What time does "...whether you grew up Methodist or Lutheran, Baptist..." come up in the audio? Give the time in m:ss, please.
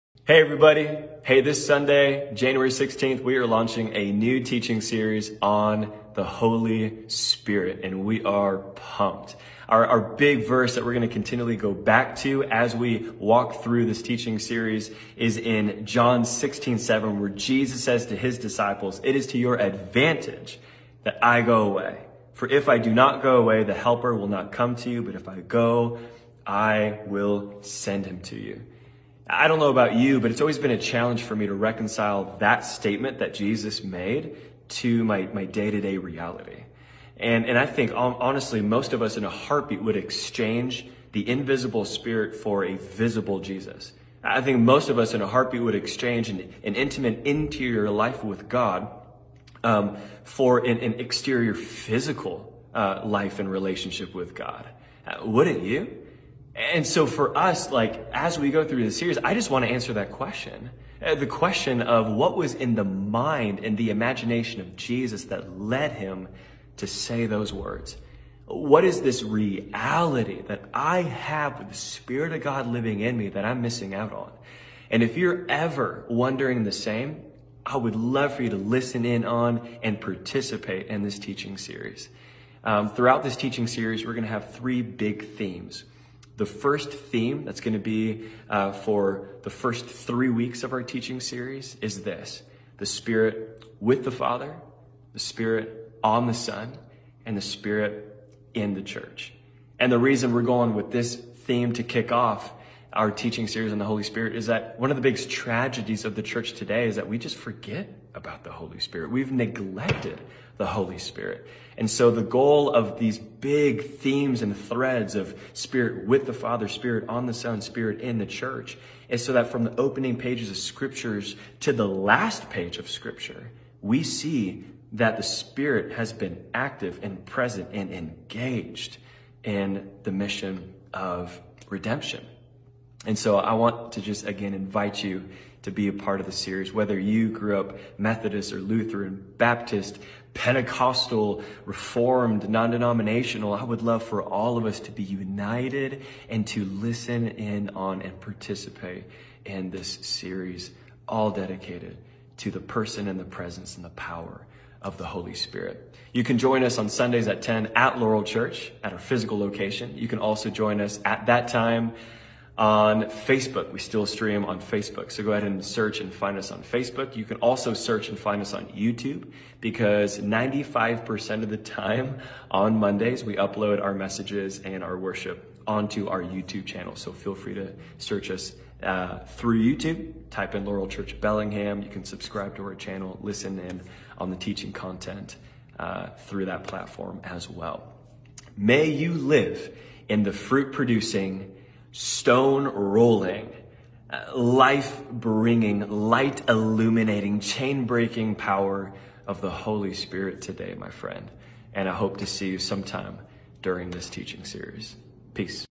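2:16.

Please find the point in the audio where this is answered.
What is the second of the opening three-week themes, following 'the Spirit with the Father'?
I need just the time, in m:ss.
1:35.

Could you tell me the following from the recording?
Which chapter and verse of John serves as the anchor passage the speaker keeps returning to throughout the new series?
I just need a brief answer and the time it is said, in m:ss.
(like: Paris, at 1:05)
John 16:7, at 0:15.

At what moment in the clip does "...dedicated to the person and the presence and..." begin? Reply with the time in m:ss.
2:31.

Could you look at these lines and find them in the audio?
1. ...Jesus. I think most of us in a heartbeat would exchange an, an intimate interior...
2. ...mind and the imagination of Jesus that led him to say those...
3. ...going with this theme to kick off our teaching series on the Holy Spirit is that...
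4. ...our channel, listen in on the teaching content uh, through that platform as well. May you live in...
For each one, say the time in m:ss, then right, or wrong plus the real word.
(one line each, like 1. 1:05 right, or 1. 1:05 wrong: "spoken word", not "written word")
1. 0:43 right
2. 1:02 right
3. 1:40 right
4. 3:02 right.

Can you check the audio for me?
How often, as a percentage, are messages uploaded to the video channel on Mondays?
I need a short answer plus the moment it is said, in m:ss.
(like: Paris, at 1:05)
95%, at 2:50.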